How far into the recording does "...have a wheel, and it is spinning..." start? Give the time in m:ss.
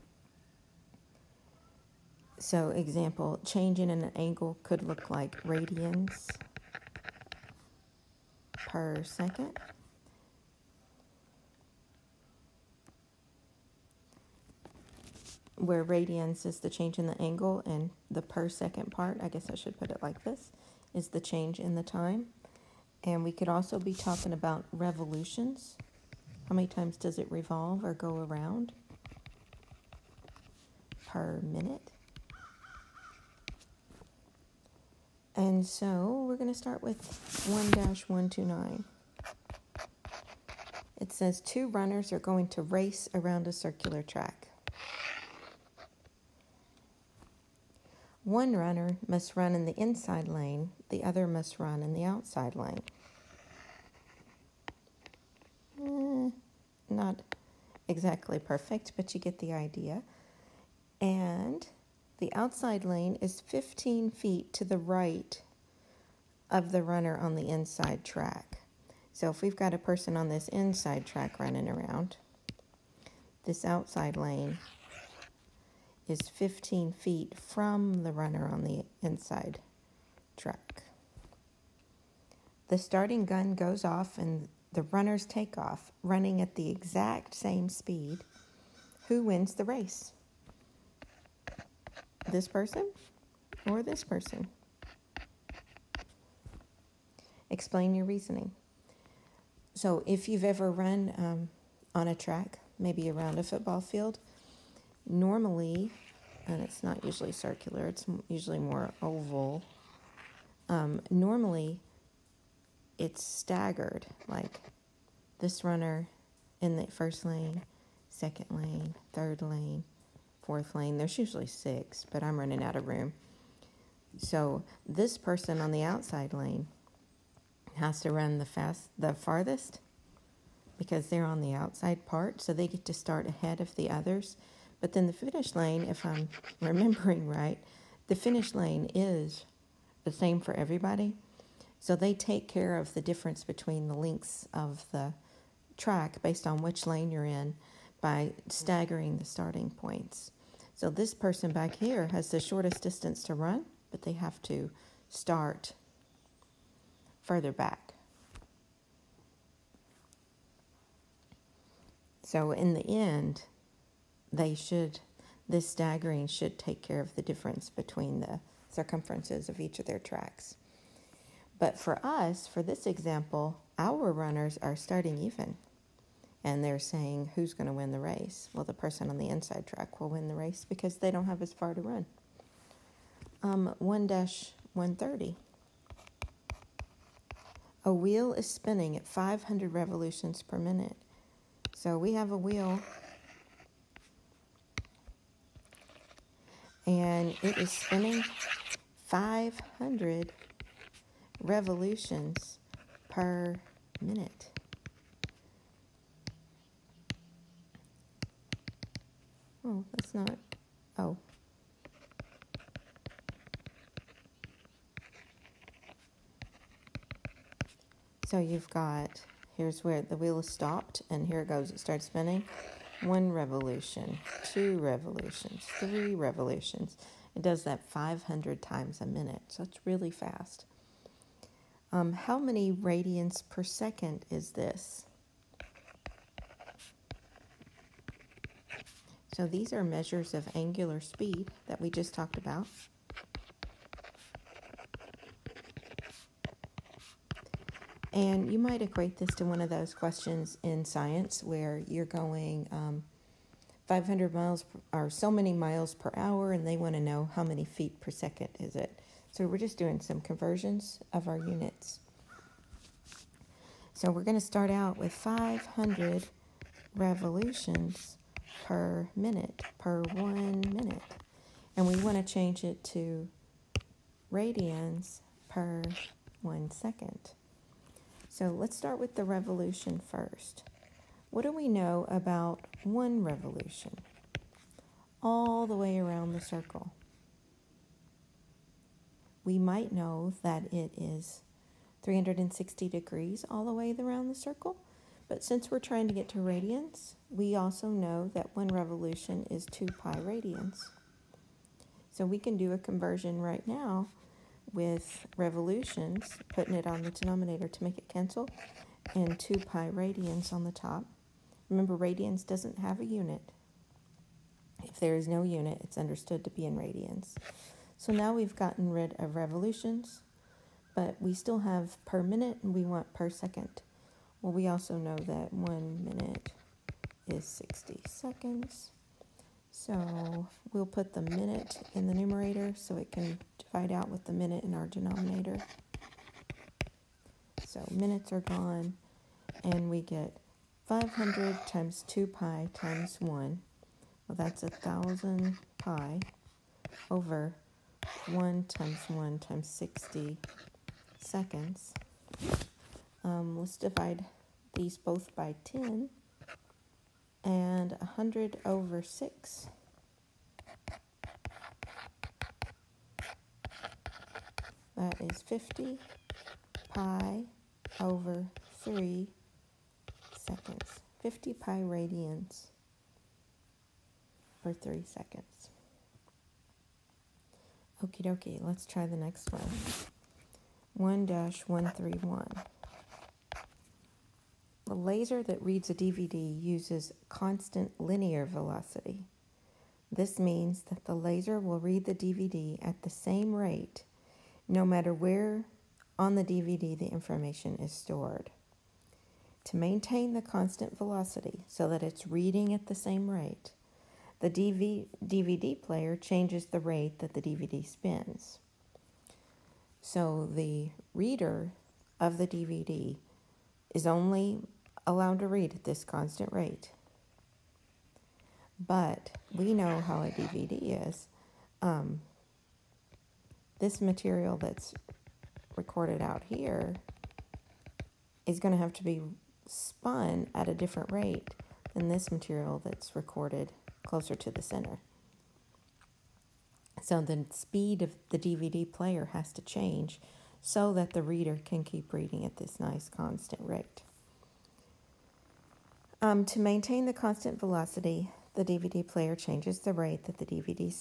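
3:12.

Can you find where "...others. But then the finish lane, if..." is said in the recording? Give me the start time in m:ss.
2:13.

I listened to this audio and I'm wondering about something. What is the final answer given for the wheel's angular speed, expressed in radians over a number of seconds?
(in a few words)
50 pi over 3 seconds.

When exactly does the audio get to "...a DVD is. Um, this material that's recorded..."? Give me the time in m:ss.
7:00.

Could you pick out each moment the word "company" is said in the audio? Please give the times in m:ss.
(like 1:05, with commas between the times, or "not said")
not said.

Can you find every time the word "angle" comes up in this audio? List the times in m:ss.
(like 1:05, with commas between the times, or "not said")
0:04, 0:17.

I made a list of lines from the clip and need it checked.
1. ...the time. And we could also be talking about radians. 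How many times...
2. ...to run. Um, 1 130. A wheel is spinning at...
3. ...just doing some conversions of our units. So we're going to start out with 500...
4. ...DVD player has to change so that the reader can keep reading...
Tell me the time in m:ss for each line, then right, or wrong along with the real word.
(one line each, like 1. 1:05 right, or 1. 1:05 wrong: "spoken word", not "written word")
1. 0:21 wrong: "revolutions", not "radians"
2. 3:01 right
3. 4:19 right
4. 7:18 right.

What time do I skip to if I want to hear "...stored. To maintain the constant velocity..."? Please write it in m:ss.
6:37.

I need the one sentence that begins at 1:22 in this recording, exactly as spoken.
The starting gun goes off and the runners take off, running at the exact same speed.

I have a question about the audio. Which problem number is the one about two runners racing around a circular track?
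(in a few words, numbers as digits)
1-129.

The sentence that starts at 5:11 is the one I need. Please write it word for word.
Remember, radians doesn't have a unit.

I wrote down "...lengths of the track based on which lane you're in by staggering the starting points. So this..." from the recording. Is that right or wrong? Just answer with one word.
right.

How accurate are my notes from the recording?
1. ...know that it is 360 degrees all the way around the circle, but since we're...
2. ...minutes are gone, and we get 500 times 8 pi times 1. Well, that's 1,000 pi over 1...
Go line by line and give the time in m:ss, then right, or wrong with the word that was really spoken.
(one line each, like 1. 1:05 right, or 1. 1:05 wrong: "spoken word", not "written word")
1. 4:49 right
2. 5:37 wrong: "2", not "8".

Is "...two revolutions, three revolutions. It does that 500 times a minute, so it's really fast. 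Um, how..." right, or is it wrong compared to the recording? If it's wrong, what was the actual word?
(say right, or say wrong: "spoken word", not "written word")
right.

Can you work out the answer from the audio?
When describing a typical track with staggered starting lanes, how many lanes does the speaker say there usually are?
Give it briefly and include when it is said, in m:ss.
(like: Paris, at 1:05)
6, at 2:01.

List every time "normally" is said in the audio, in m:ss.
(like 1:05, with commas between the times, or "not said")
1:45, 1:51.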